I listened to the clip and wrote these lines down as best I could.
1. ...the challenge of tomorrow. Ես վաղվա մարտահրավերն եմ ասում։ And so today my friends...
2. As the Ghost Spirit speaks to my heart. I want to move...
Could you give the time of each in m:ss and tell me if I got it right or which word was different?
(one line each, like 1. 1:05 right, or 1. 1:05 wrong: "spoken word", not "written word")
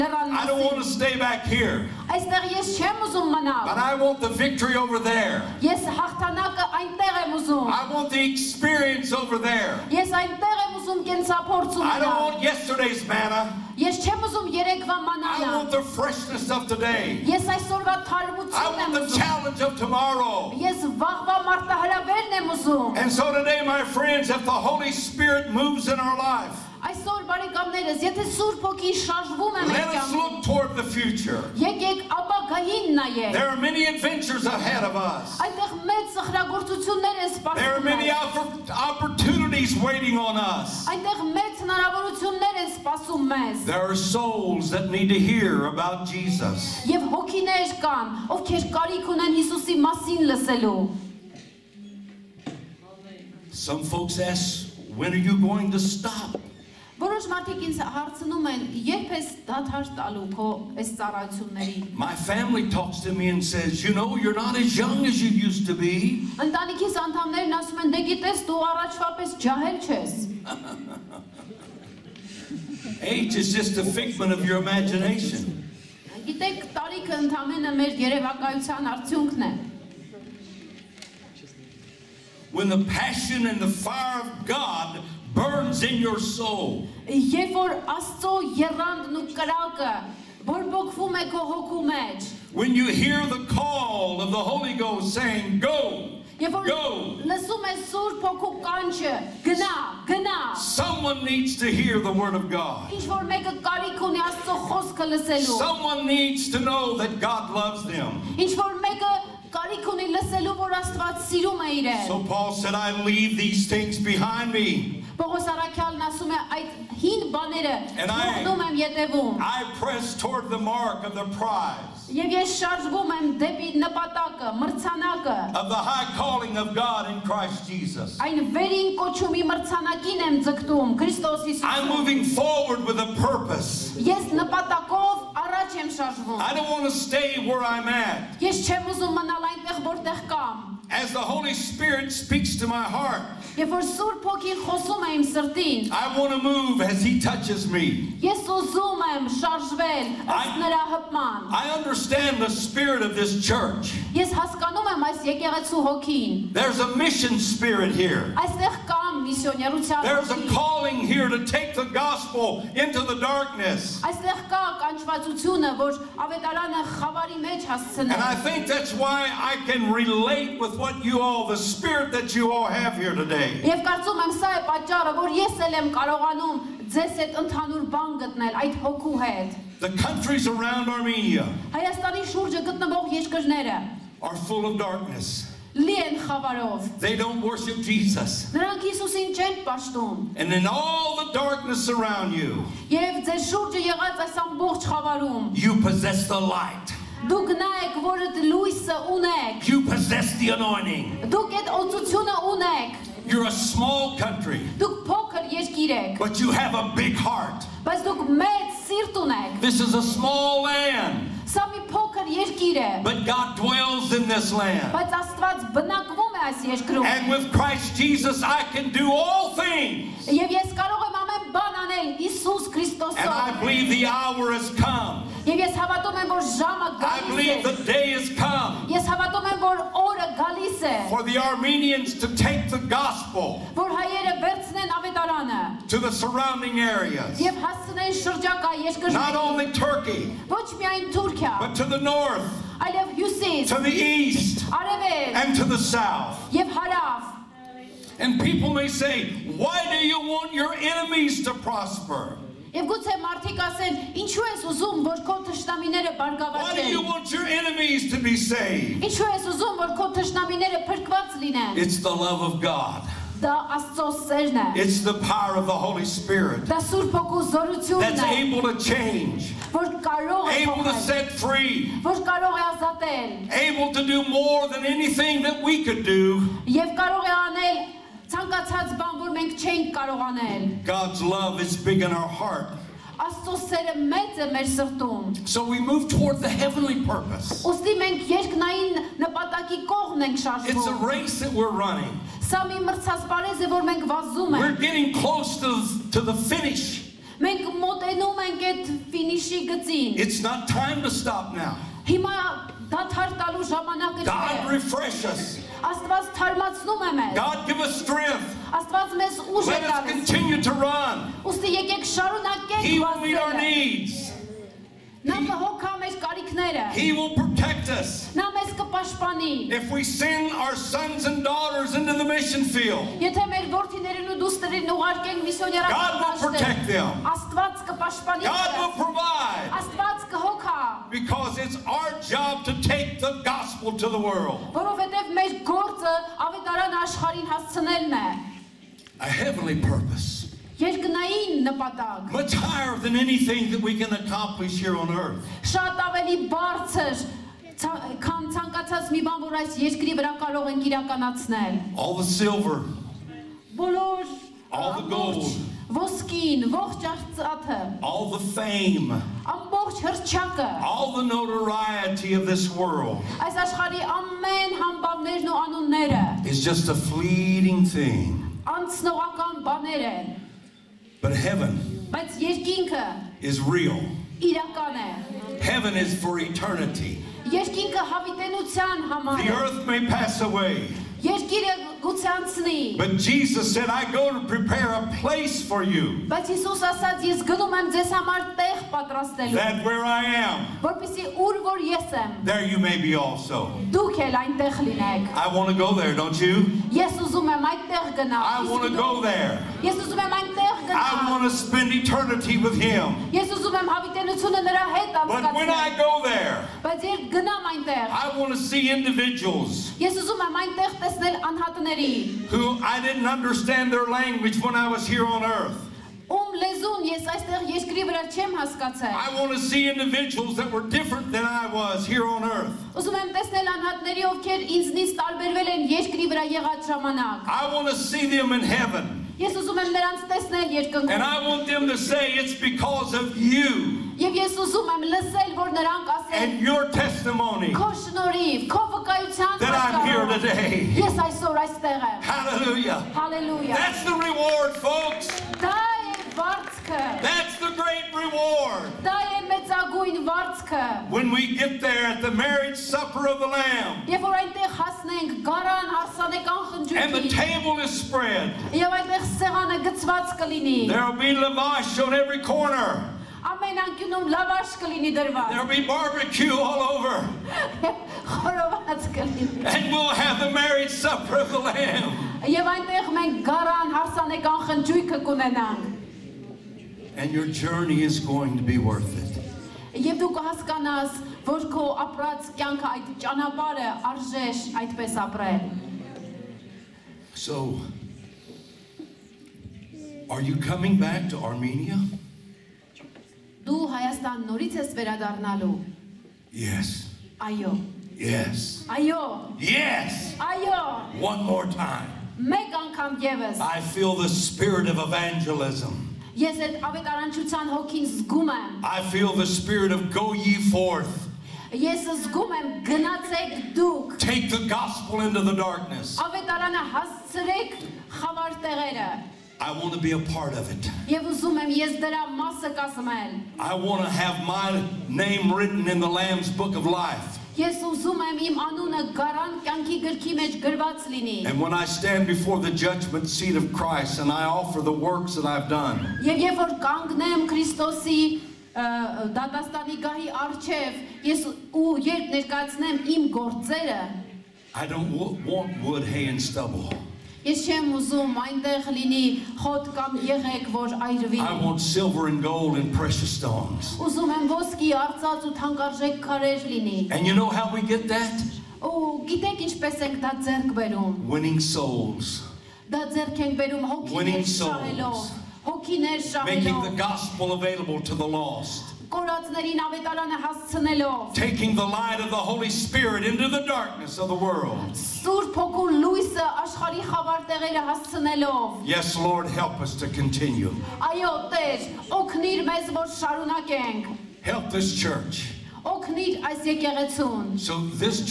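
1. 0:18 wrong: "ուզում", not "ասում"
2. 2:20 wrong: "Holy", not "Ghost".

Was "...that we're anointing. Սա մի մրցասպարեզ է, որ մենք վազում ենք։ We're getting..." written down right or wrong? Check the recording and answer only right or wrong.
wrong.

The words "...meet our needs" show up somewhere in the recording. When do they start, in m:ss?
5:13.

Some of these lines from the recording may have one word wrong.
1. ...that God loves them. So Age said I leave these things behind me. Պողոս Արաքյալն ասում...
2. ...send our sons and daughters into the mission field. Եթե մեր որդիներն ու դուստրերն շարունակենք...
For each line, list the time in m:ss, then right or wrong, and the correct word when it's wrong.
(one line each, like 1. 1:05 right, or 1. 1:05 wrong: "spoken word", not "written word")
1. 1:46 wrong: "Paul", not "Age"
2. 5:20 wrong: "ուղարկենք", not "շարունակենք".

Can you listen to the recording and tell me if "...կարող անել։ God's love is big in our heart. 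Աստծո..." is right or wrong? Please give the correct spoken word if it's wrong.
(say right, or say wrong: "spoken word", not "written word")
right.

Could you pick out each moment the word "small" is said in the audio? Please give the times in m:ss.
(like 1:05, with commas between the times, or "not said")
3:23, 3:30.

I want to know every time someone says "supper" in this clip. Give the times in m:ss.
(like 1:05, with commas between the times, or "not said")
7:32, 7:50.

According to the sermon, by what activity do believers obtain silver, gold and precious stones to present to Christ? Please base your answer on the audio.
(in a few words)
Winning souls.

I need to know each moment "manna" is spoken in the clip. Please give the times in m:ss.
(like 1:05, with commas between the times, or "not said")
0:13.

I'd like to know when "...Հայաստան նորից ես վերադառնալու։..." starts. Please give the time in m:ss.
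8:13.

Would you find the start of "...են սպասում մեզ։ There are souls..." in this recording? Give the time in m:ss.
0:42.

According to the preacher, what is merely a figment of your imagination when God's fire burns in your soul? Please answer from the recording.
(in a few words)
Age.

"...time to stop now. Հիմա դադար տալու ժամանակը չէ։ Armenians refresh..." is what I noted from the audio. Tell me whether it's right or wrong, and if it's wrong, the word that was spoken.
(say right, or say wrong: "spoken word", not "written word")
wrong: "God", not "Armenians".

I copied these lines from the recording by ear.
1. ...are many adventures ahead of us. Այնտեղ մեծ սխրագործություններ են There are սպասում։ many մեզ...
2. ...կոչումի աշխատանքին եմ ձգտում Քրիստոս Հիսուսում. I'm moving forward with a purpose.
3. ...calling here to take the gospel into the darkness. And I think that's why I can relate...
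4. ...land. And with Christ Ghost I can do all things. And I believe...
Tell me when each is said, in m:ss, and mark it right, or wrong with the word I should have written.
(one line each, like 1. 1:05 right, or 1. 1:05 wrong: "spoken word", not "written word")
1. 0:33 right
2. 2:09 wrong: "մրցանակին", not "աշխատանքին"
3. 2:40 right
4. 3:34 wrong: "Jesus", not "Ghost".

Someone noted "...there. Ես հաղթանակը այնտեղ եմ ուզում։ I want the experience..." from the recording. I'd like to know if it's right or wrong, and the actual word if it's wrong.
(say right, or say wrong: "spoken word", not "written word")
right.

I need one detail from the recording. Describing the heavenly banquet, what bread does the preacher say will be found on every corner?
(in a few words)
lavash.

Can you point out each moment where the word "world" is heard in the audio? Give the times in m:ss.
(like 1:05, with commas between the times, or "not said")
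5:34, 6:02, 9:34.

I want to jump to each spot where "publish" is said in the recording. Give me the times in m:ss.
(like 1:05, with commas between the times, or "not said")
not said.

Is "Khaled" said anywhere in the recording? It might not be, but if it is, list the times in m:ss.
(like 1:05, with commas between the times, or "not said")
not said.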